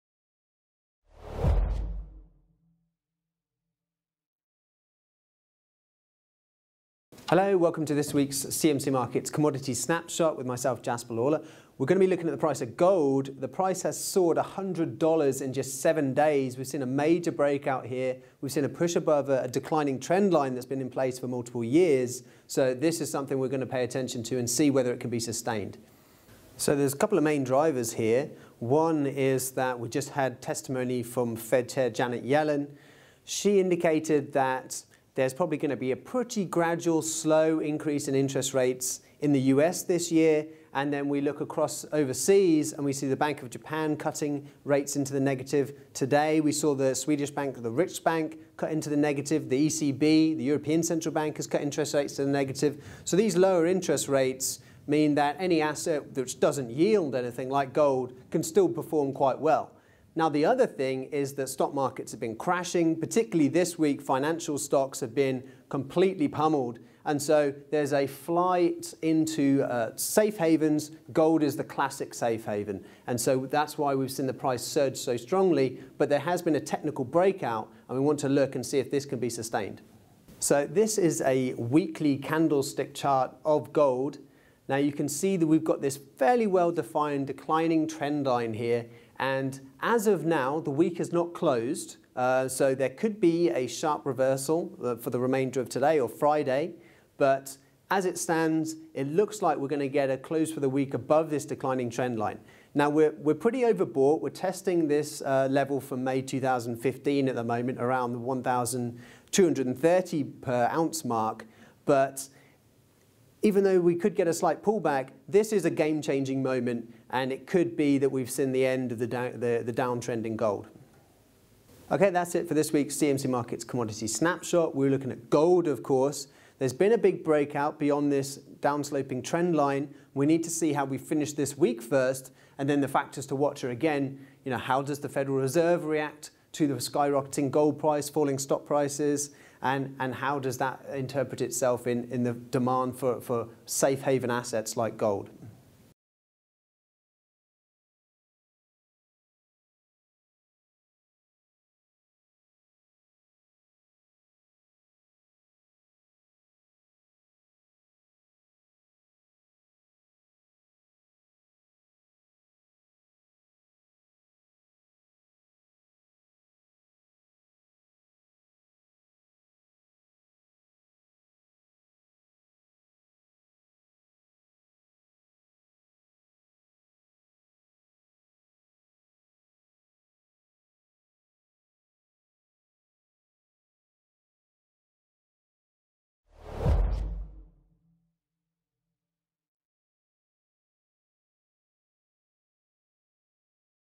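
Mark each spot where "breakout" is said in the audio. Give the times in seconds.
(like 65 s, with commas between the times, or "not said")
17 s, 77 s, 127 s.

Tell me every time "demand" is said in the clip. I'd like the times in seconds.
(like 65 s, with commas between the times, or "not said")
142 s.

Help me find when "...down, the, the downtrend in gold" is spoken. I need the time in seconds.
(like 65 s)
119 s.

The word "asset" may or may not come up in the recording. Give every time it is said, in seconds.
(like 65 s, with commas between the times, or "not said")
55 s, 144 s.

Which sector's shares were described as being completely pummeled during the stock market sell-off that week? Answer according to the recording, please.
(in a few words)
Financial stocks.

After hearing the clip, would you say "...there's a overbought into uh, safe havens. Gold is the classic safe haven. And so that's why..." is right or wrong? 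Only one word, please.
wrong.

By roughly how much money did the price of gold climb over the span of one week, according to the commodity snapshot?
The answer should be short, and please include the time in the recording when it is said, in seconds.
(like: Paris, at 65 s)
$100, at 14 s.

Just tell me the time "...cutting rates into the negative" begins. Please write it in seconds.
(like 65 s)
43 s.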